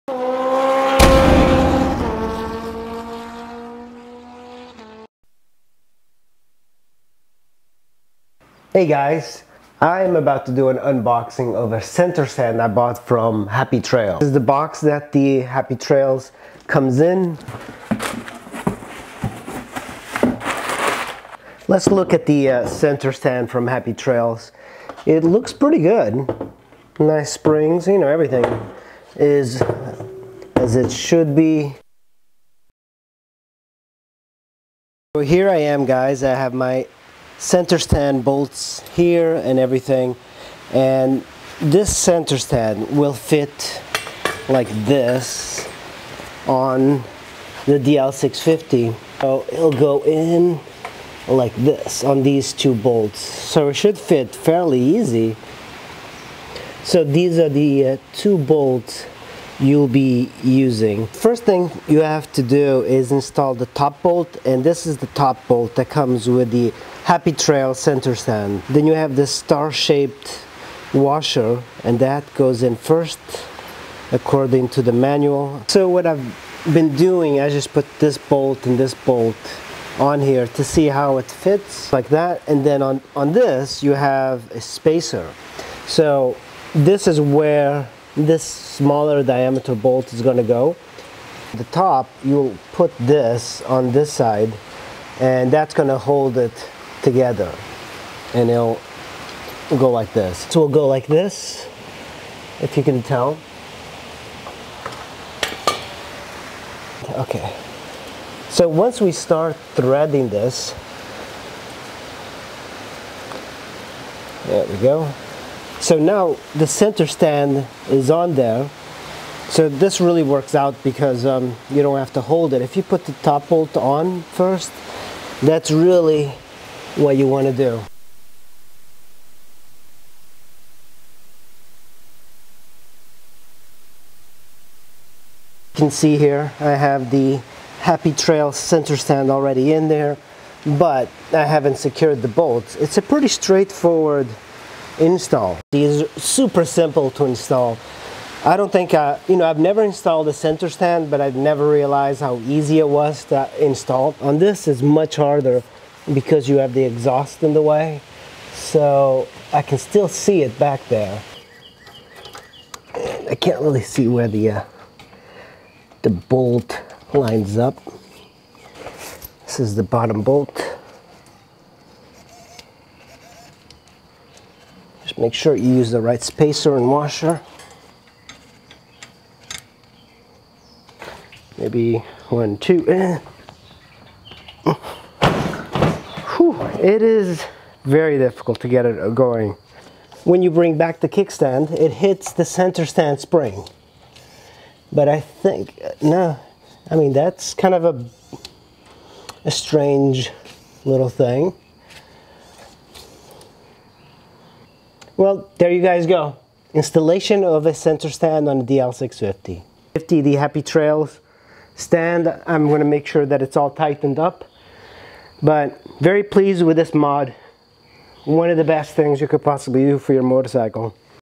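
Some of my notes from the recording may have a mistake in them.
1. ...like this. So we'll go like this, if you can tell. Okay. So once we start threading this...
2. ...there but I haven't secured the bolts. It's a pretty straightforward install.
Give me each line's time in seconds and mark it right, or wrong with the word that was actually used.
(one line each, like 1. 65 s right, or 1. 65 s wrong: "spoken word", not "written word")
1. 99 s right
2. 139 s right.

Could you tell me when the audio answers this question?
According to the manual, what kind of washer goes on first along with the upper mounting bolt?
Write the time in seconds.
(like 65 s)
69 s.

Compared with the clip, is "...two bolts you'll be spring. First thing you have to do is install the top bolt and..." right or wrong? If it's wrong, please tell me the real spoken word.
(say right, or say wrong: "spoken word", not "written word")
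wrong: "using", not "spring".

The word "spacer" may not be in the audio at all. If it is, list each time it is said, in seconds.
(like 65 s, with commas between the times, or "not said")
84 s, 176 s.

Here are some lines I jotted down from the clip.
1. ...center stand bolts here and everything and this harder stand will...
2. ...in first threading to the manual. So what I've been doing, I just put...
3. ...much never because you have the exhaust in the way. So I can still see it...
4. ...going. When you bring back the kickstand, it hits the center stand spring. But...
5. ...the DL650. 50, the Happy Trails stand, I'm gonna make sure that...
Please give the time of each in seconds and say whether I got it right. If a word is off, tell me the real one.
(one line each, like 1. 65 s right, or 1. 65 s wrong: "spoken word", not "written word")
1. 37 s wrong: "center", not "harder"
2. 72 s wrong: "according", not "threading"
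3. 154 s wrong: "harder", not "never"
4. 189 s right
5. 208 s right.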